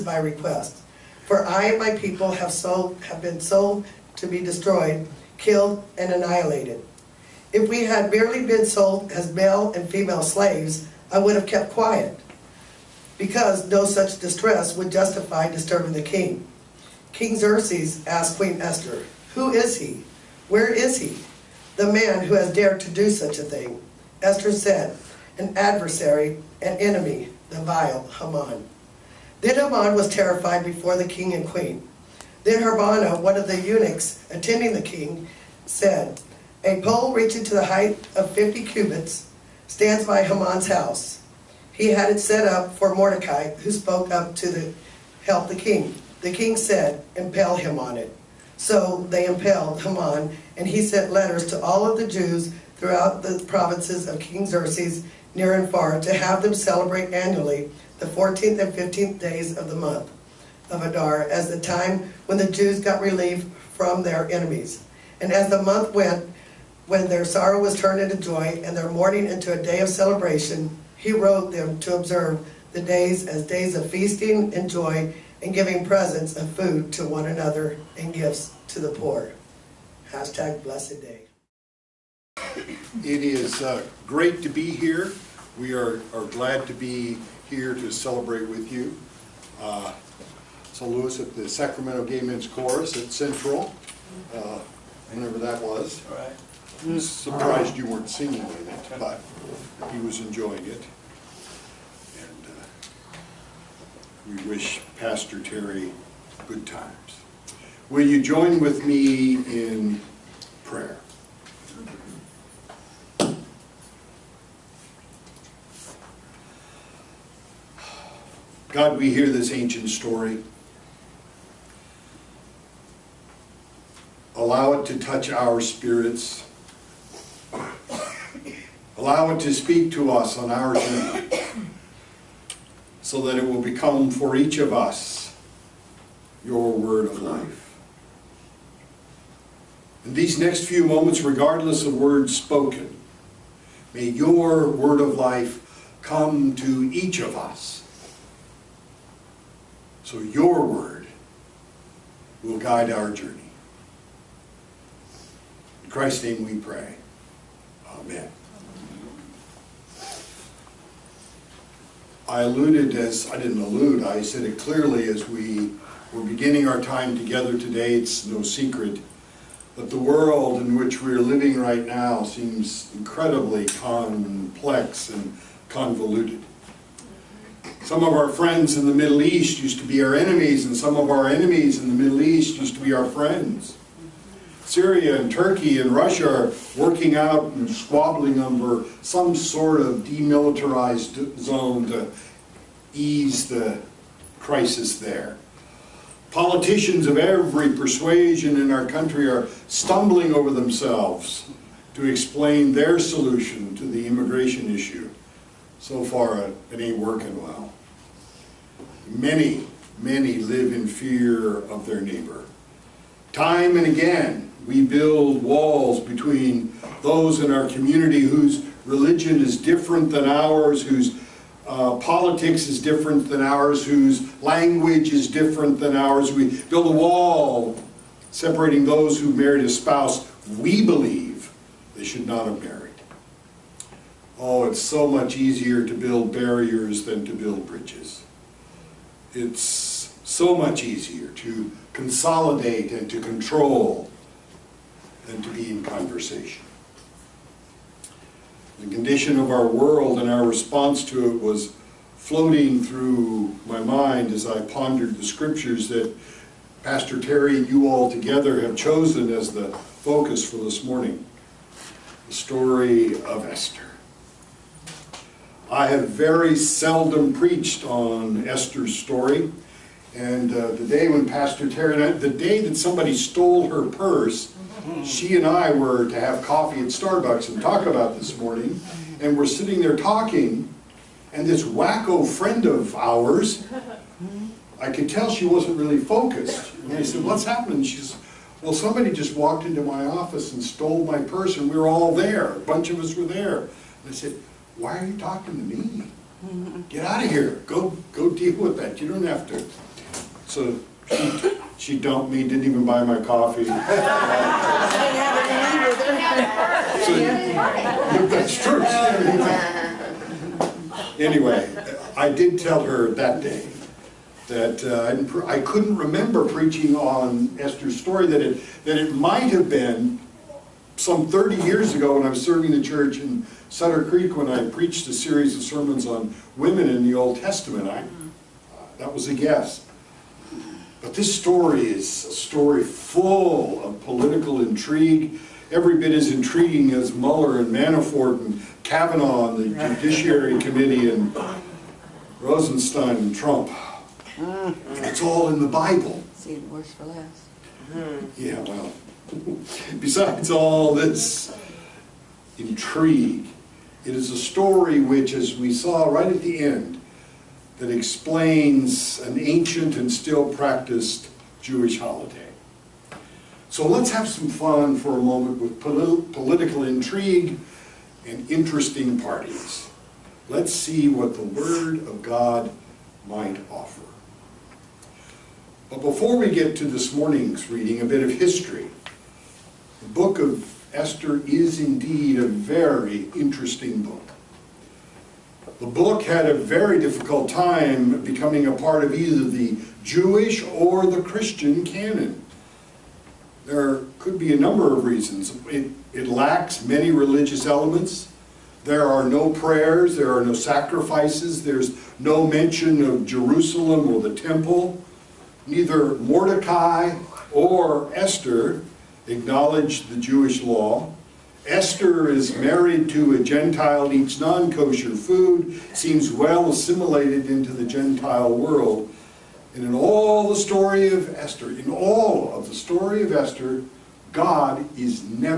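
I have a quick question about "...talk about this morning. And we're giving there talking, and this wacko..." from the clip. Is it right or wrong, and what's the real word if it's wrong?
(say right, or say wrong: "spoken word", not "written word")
wrong: "sitting", not "giving".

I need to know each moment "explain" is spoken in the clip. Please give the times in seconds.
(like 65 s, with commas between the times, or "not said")
202 s, 357 s.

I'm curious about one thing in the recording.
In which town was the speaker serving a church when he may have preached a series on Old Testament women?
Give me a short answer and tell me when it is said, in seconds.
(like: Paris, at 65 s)
Sutter Creek, at 323 s.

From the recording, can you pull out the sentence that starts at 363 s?
So let's have some fun for a moment with polit political intrigue and interesting parties.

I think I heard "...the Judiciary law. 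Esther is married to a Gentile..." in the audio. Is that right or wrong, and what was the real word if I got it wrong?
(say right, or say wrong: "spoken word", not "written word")
wrong: "Jewish", not "Judiciary".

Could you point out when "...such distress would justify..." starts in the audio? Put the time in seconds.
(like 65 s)
13 s.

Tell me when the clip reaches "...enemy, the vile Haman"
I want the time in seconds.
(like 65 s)
26 s.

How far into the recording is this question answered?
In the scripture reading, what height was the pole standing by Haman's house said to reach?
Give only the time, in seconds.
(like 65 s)
38 s.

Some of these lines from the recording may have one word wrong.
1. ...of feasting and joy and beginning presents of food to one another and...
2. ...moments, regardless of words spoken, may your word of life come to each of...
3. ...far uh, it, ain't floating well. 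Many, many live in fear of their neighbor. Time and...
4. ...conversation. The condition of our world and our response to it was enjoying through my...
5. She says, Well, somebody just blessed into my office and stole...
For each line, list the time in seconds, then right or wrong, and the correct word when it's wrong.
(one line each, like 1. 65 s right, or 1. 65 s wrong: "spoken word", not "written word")
1. 73 s wrong: "giving", not "beginning"
2. 140 s right
3. 206 s wrong: "working", not "floating"
4. 245 s wrong: "floating", not "enjoying"
5. 287 s wrong: "walked", not "blessed".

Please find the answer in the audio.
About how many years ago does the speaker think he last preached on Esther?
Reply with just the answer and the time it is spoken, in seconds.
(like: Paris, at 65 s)
30, at 321 s.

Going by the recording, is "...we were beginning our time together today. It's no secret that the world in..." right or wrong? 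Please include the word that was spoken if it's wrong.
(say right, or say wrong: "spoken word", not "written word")
right.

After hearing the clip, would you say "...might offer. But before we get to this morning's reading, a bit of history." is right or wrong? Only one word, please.
right.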